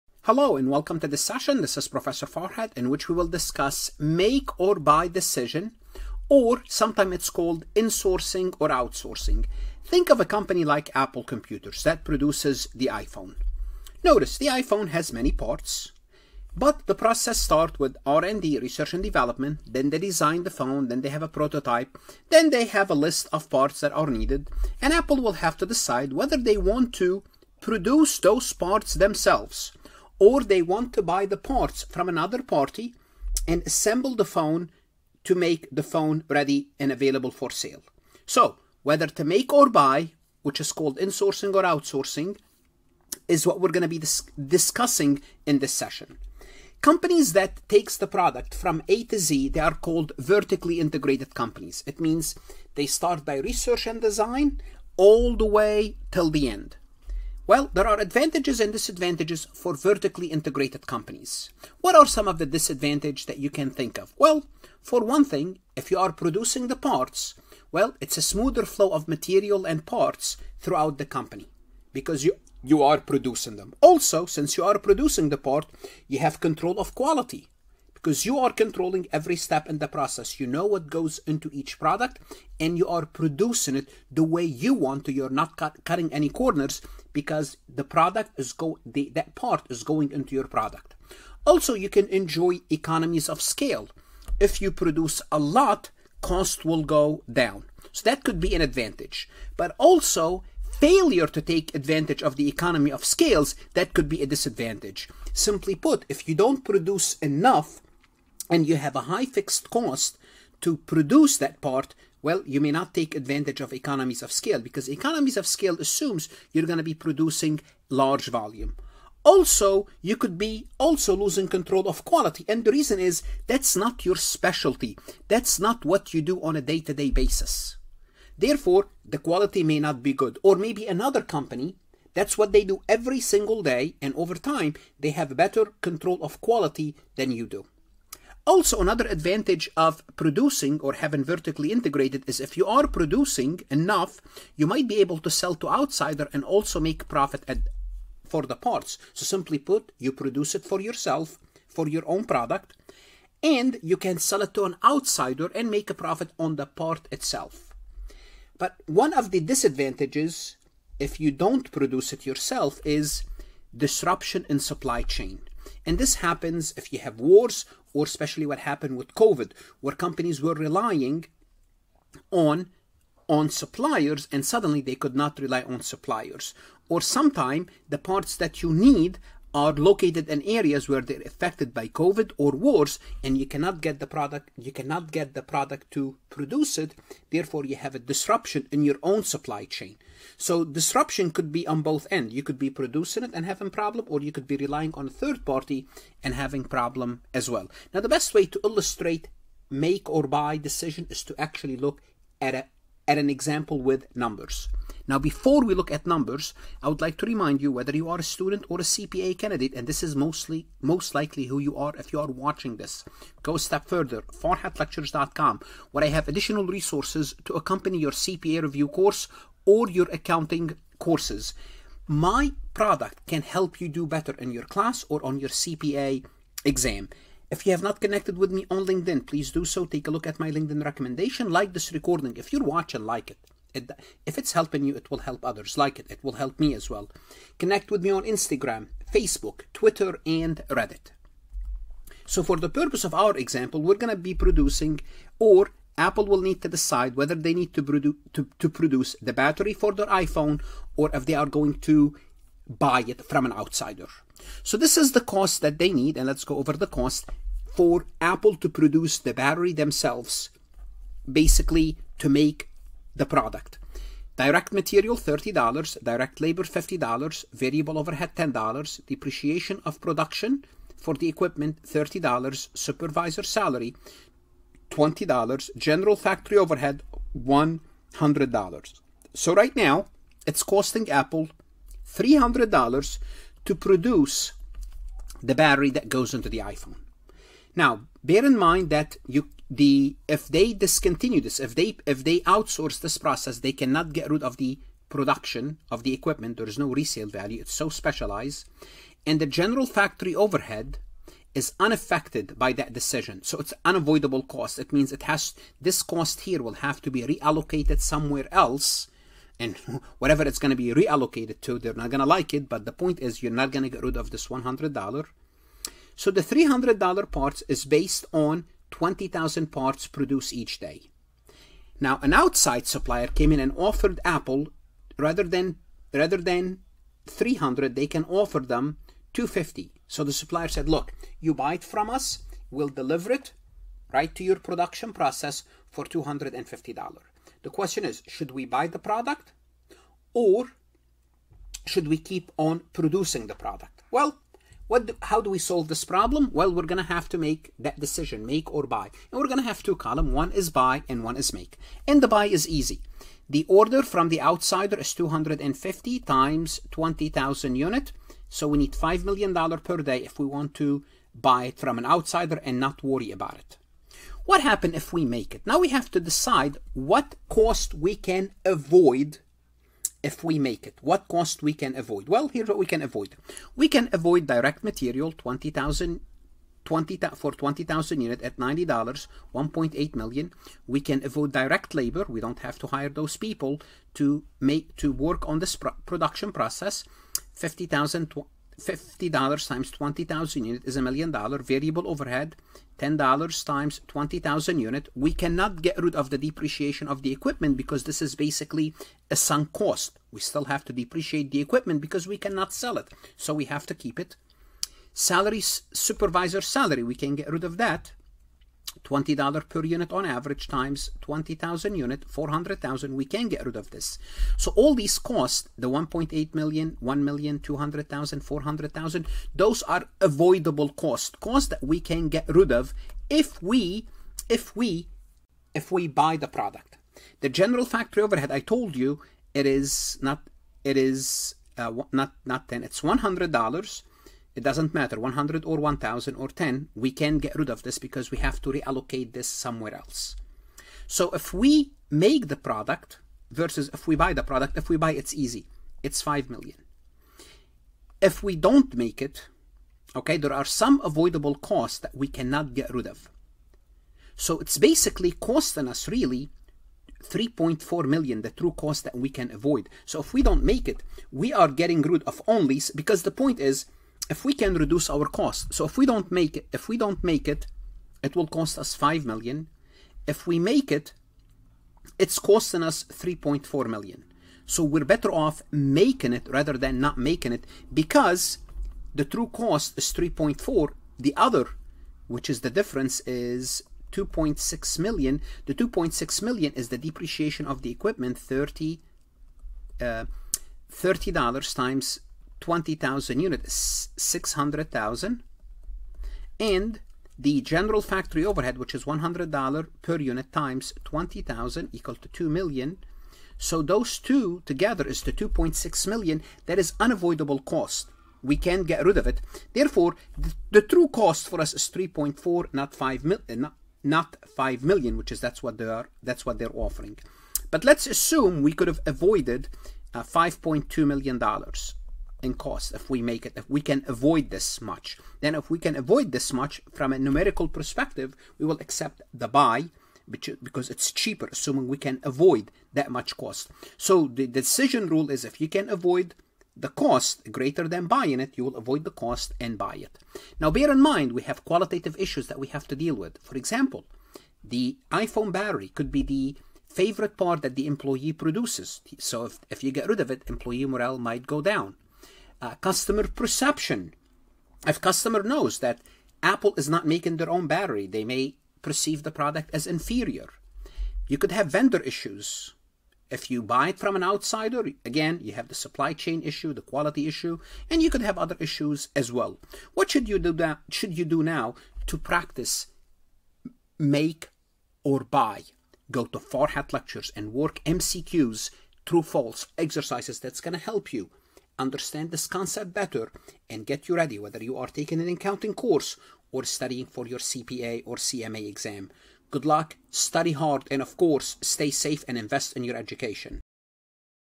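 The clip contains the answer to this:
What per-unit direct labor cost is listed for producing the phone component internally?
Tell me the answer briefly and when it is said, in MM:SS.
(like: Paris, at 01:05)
$50, at 04:26.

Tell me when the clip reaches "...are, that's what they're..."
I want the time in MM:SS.
08:35.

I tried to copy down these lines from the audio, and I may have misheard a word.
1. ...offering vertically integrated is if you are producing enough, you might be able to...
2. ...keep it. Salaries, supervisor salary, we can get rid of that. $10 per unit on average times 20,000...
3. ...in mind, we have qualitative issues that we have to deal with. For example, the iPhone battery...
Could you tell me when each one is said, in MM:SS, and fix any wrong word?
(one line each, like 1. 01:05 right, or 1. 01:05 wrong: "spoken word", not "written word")
1. 02:20 wrong: "having", not "offering"
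2. 06:43 wrong: "20", not "10"
3. 09:00 right.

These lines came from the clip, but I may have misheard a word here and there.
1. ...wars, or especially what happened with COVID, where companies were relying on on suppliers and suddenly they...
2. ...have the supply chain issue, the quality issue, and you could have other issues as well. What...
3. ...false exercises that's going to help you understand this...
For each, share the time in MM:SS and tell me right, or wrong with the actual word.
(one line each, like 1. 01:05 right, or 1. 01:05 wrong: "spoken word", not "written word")
1. 02:47 right
2. 09:25 right
3. 09:39 right.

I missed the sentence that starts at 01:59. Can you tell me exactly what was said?
Also, you could be also losing control of quality.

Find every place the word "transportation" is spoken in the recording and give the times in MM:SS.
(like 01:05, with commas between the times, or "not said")
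not said.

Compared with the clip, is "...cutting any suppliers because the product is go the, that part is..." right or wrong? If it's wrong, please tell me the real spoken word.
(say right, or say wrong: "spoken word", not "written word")
wrong: "corners", not "suppliers".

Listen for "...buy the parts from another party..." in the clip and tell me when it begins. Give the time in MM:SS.
00:31.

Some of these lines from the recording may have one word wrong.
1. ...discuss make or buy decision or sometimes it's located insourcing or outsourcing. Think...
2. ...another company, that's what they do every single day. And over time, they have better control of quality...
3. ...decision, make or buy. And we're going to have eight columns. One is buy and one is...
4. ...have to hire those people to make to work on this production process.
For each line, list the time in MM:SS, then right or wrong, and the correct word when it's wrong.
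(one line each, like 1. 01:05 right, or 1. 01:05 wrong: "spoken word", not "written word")
1. 00:03 wrong: "called", not "located"
2. 02:10 right
3. 05:47 wrong: "two", not "eight"
4. 06:22 right.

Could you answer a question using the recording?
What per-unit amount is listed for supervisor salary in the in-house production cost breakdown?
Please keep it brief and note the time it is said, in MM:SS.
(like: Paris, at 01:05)
$20, at 04:32.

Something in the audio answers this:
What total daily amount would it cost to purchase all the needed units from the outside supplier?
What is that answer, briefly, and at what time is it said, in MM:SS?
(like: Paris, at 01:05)
$5 million, at 05:58.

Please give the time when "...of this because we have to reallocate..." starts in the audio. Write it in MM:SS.
07:17.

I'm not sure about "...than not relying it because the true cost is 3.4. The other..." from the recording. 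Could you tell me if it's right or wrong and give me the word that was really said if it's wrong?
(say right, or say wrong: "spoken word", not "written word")
wrong: "making", not "relying".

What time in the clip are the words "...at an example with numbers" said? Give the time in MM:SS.
03:23.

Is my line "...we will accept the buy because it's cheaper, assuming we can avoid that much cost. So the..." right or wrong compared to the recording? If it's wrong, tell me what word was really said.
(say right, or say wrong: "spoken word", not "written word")
right.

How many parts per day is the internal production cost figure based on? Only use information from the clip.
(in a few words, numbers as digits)
20,000.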